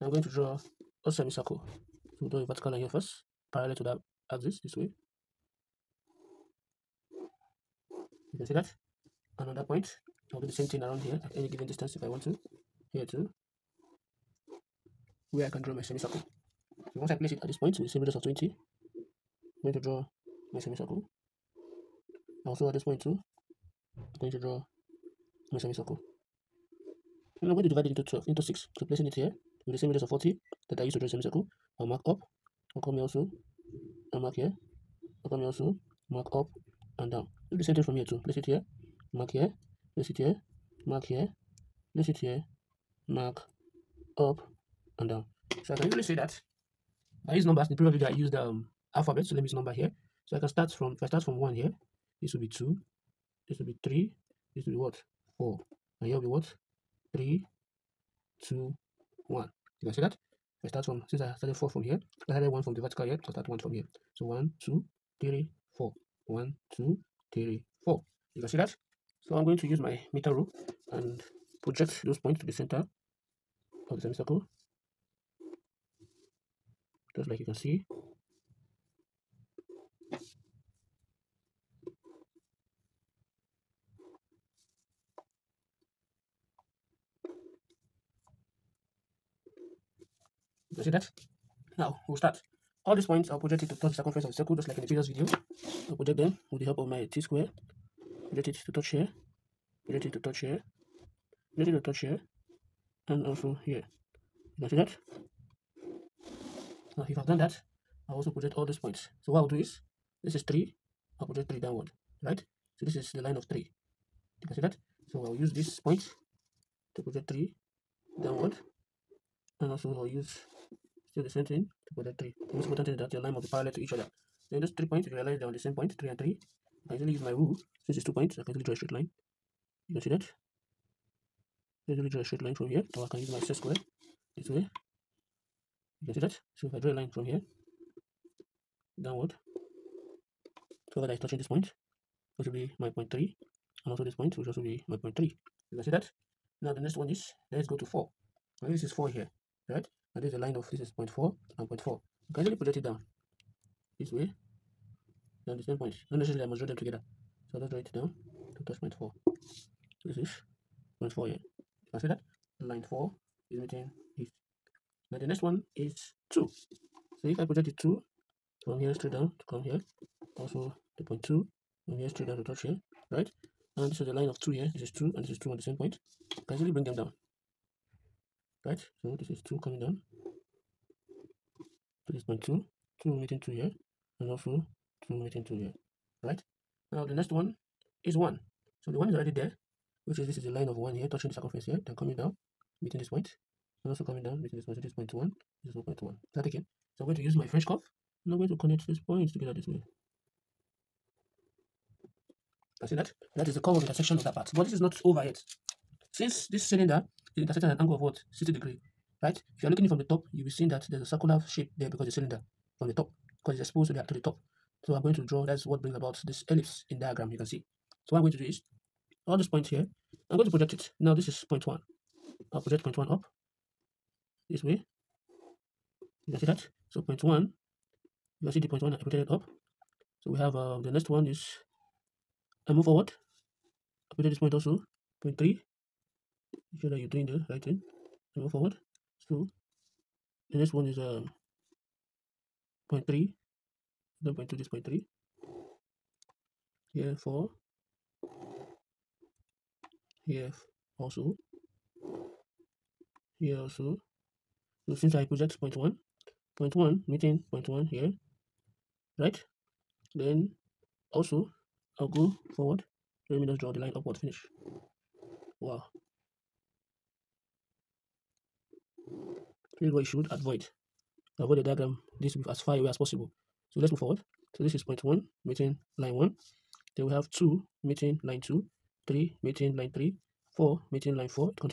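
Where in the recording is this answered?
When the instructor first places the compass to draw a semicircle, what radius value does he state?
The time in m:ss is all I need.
0:18.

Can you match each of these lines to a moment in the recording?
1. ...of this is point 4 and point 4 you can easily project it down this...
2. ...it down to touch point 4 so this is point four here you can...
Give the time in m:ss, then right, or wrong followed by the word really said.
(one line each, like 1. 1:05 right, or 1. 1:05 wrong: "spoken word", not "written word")
1. 2:30 right
2. 2:37 right.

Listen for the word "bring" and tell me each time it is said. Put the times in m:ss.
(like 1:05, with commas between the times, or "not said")
2:56, 3:35.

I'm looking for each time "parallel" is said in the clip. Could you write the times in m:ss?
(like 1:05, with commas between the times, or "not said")
0:03, 2:03.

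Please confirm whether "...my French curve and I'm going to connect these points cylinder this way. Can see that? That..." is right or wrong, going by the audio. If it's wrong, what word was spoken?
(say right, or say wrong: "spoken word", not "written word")
wrong: "together", not "cylinder".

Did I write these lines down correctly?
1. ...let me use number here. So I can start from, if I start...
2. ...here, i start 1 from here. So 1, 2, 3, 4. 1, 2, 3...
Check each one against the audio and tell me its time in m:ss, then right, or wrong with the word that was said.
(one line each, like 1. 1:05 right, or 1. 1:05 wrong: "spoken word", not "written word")
1. 0:49 right
2. 1:03 right.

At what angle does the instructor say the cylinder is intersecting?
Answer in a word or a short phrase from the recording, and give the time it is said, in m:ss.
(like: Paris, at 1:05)
60 degrees, at 3:28.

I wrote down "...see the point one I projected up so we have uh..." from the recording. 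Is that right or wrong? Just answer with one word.
right.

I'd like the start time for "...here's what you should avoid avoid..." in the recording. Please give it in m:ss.
4:29.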